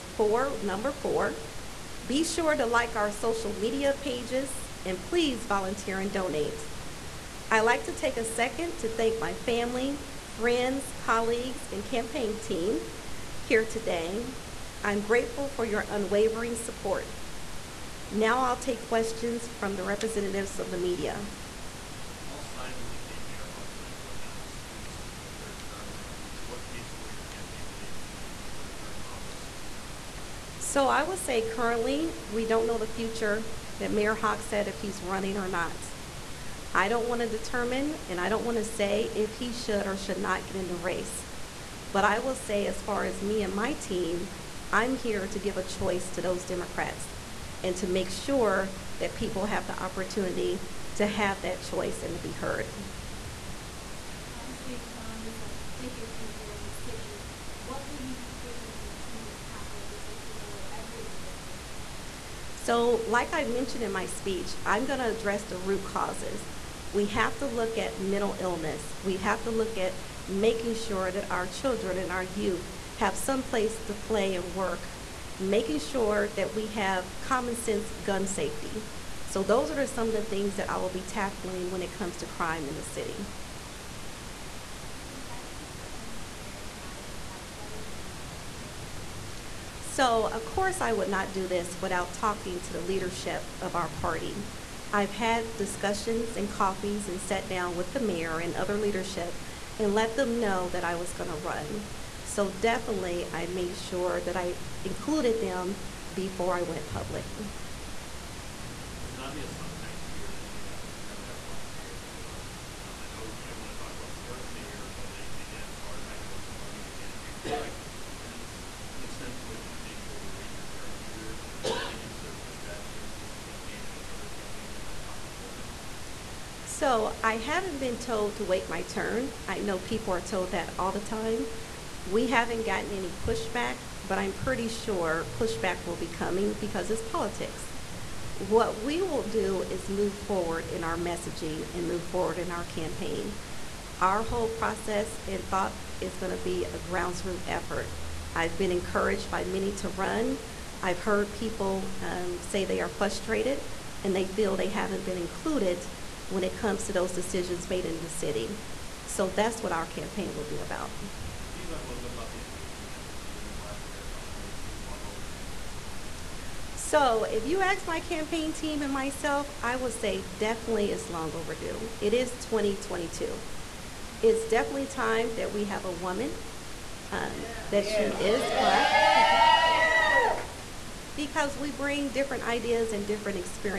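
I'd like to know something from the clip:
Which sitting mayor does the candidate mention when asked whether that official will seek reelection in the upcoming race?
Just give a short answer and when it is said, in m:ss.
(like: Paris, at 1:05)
Hogsett, at 0:34.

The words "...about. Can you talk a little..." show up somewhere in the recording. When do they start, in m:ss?
2:40.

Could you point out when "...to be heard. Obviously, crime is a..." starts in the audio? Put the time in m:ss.
0:52.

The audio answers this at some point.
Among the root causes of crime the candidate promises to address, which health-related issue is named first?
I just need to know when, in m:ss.
1:07.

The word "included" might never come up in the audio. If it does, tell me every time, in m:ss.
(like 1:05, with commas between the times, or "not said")
1:44, 2:35.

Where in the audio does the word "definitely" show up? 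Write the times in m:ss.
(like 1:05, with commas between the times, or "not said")
1:42, 2:50, 2:54.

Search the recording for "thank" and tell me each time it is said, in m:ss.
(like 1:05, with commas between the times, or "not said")
0:08.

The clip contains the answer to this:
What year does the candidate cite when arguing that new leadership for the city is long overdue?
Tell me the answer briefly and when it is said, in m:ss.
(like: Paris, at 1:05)
2022, at 2:52.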